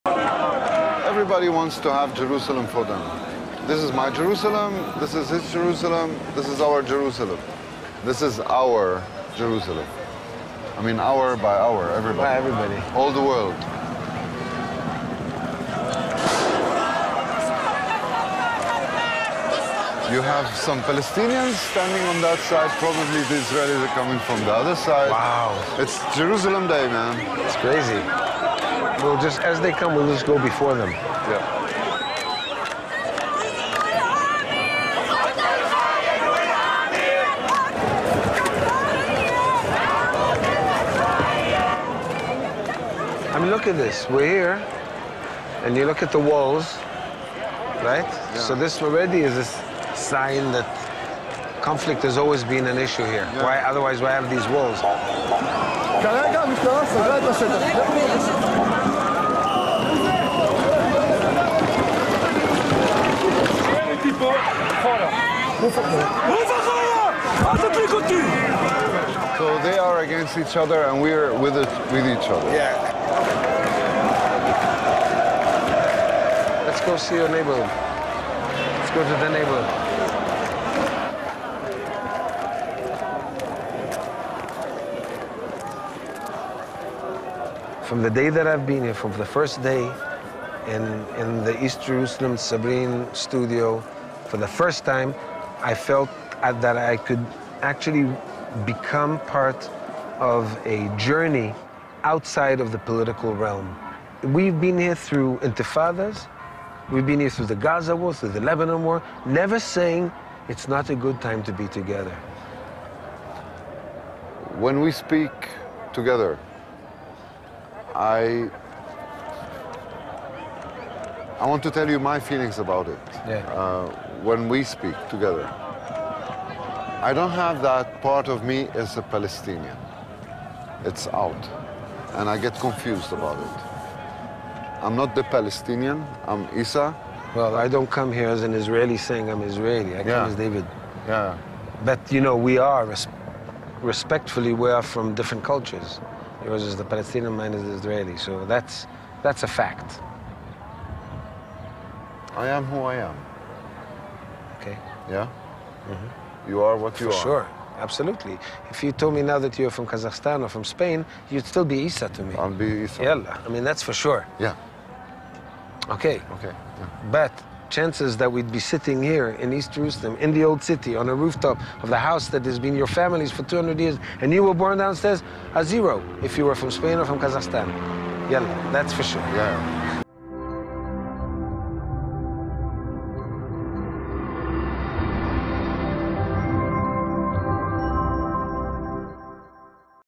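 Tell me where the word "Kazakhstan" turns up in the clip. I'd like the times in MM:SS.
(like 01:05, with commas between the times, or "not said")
02:39, 02:57.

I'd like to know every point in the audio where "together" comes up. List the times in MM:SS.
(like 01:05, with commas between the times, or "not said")
01:51, 01:55, 02:05.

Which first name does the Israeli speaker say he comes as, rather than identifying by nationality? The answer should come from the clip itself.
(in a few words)
David.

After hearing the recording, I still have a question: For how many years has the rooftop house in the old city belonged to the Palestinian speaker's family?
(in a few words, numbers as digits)
200.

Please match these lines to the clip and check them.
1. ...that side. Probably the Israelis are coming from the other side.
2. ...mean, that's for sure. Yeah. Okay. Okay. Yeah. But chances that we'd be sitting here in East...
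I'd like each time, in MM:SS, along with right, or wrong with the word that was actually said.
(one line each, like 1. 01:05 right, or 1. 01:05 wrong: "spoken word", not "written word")
1. 00:22 right
2. 02:43 right.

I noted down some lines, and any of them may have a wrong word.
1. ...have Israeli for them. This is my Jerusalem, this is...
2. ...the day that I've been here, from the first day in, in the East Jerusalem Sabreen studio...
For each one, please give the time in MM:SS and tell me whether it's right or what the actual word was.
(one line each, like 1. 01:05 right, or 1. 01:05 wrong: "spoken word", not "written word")
1. 00:01 wrong: "Jerusalem", not "Israeli"
2. 01:28 right.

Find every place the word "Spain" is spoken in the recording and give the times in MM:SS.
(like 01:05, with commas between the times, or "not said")
02:40, 02:56.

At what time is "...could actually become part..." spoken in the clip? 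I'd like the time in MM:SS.
01:36.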